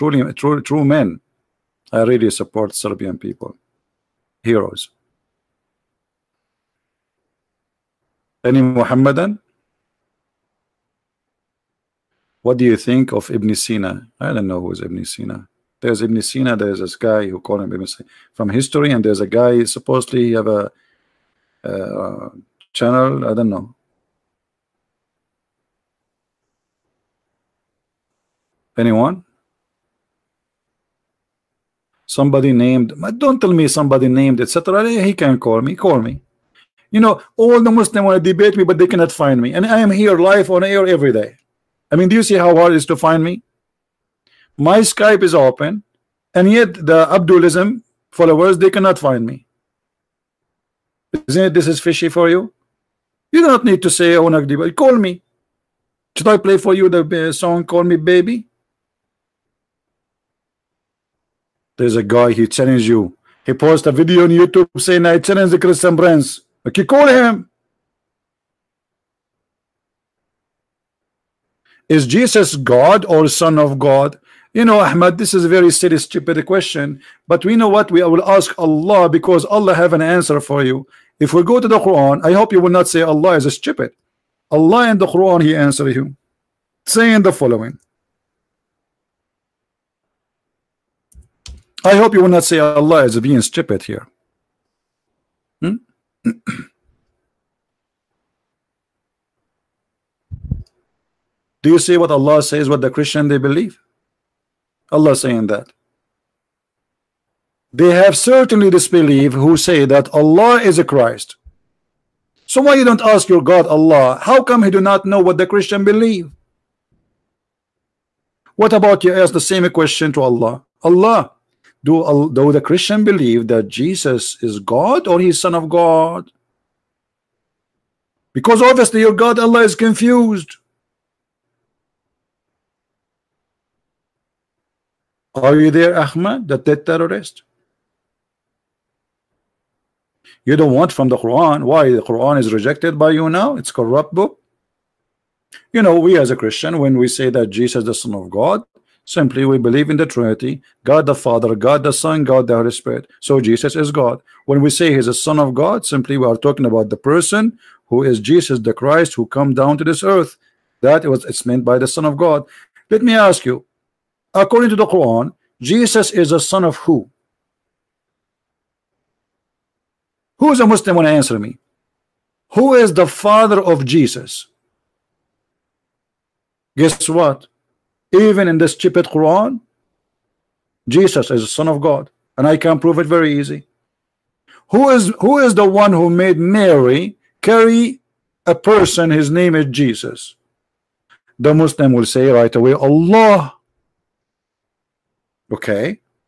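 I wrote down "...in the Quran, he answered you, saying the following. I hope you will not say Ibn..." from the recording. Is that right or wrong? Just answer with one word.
wrong.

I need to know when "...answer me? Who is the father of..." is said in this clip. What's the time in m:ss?
2:51.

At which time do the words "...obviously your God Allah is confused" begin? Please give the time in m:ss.
2:08.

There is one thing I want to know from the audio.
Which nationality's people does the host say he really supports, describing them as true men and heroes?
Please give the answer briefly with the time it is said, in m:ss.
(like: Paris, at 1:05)
Serbian, at 0:02.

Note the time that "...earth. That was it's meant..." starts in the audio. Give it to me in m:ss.
2:40.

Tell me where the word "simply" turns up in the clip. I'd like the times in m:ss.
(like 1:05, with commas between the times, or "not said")
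2:29, 2:35.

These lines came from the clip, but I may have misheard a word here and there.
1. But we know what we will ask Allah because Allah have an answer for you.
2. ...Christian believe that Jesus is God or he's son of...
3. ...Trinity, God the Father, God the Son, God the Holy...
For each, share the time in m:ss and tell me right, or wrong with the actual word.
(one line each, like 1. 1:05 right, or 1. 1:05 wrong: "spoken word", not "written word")
1. 1:17 right
2. 2:02 right
3. 2:30 right.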